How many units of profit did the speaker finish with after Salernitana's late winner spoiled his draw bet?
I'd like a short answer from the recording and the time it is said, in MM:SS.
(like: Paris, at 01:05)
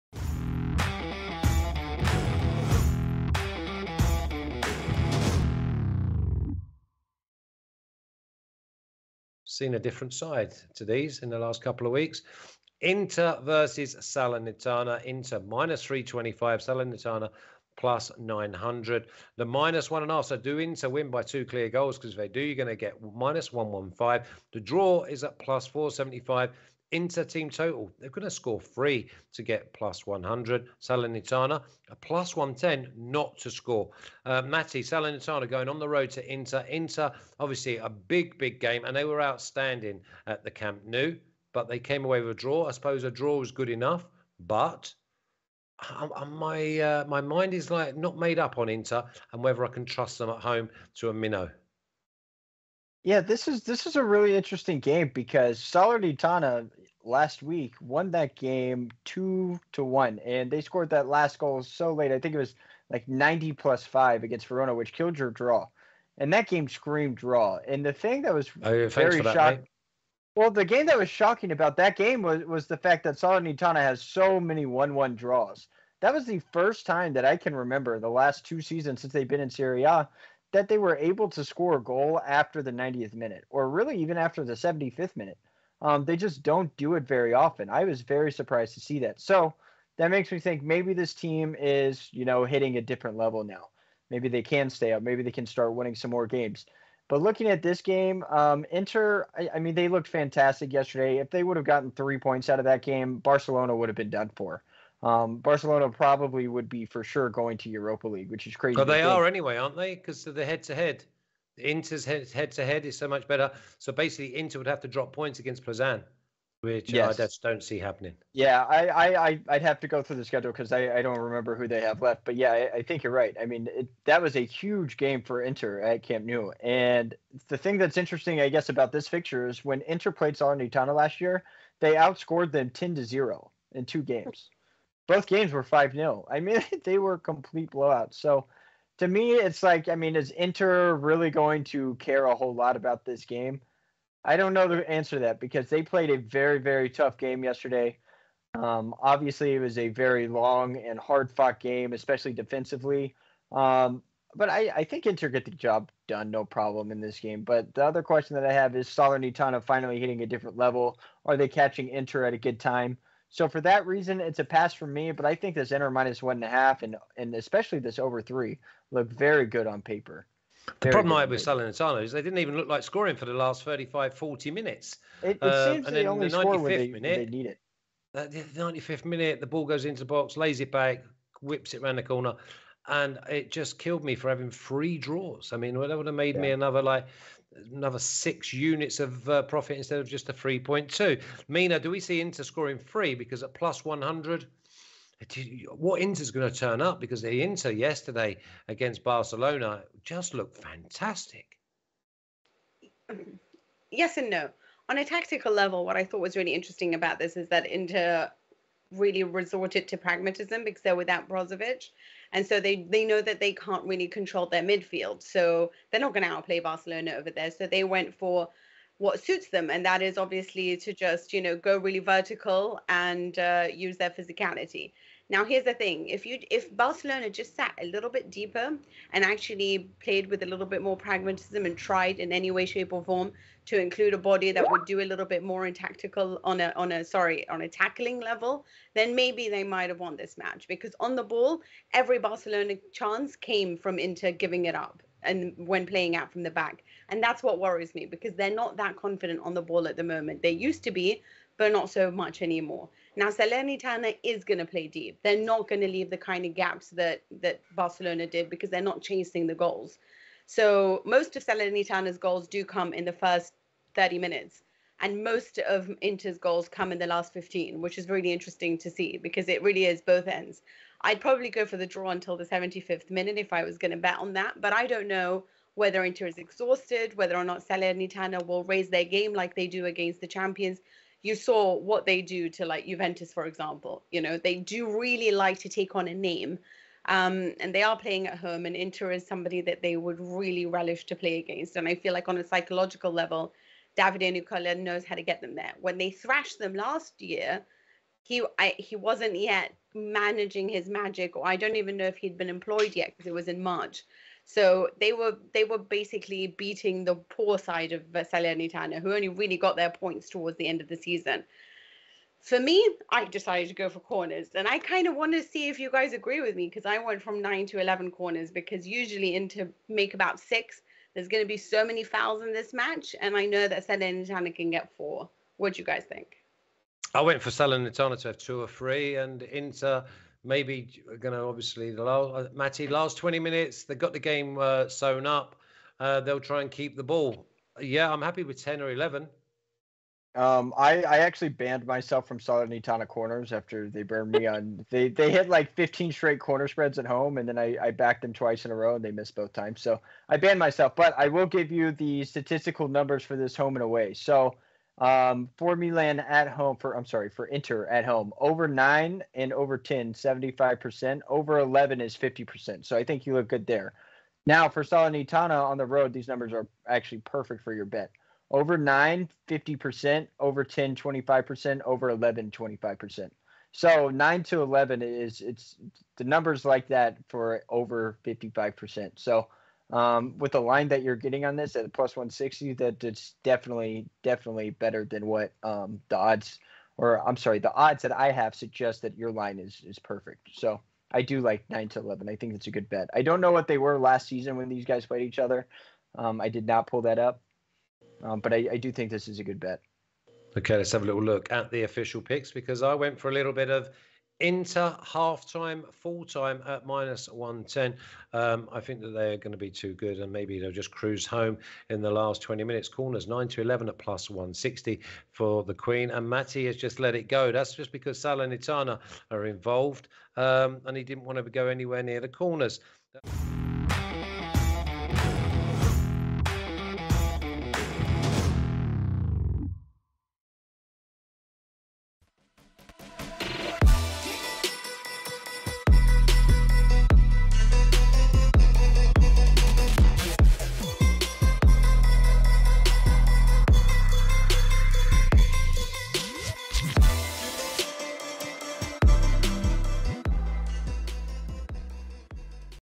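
3.2, at 03:10.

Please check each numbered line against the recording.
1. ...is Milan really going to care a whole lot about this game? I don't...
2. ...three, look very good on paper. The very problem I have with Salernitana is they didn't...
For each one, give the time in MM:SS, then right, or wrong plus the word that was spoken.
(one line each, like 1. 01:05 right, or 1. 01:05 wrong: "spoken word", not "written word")
1. 02:20 wrong: "Inter", not "Milan"
2. 02:48 right.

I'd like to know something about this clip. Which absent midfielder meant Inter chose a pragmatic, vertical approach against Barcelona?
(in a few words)
Brozovic.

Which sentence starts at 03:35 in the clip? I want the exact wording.
So they're not going to outplay Barcelona over there.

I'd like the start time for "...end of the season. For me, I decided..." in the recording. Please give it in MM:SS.
05:10.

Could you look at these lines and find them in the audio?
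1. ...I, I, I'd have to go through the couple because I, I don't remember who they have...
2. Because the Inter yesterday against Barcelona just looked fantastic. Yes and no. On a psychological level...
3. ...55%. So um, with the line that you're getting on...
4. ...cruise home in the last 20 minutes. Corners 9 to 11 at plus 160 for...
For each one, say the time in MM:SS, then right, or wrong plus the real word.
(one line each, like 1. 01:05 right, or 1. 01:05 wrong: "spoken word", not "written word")
1. 01:58 wrong: "schedule", not "couple"
2. 03:16 wrong: "tactical", not "psychological"
3. 06:18 right
4. 06:50 right.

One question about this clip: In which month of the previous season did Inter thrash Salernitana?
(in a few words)
March.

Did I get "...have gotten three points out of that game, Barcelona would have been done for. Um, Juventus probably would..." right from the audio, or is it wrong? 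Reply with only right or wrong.
wrong.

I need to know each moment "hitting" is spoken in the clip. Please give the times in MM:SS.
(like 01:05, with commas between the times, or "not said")
01:32, 02:39.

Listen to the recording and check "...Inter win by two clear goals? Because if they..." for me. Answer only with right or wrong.
right.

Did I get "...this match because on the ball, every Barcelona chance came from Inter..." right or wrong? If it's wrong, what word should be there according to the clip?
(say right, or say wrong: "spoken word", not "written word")
right.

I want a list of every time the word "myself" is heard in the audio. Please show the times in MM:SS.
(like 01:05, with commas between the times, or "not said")
05:41, 05:50.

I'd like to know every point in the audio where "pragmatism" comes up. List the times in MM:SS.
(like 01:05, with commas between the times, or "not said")
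03:29, 03:50.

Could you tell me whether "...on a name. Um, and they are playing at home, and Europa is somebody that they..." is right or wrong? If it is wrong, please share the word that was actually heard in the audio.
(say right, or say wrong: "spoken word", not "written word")
wrong: "Inter", not "Europa".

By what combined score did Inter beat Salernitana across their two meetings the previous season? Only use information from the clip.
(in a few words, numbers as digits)
10 to 0.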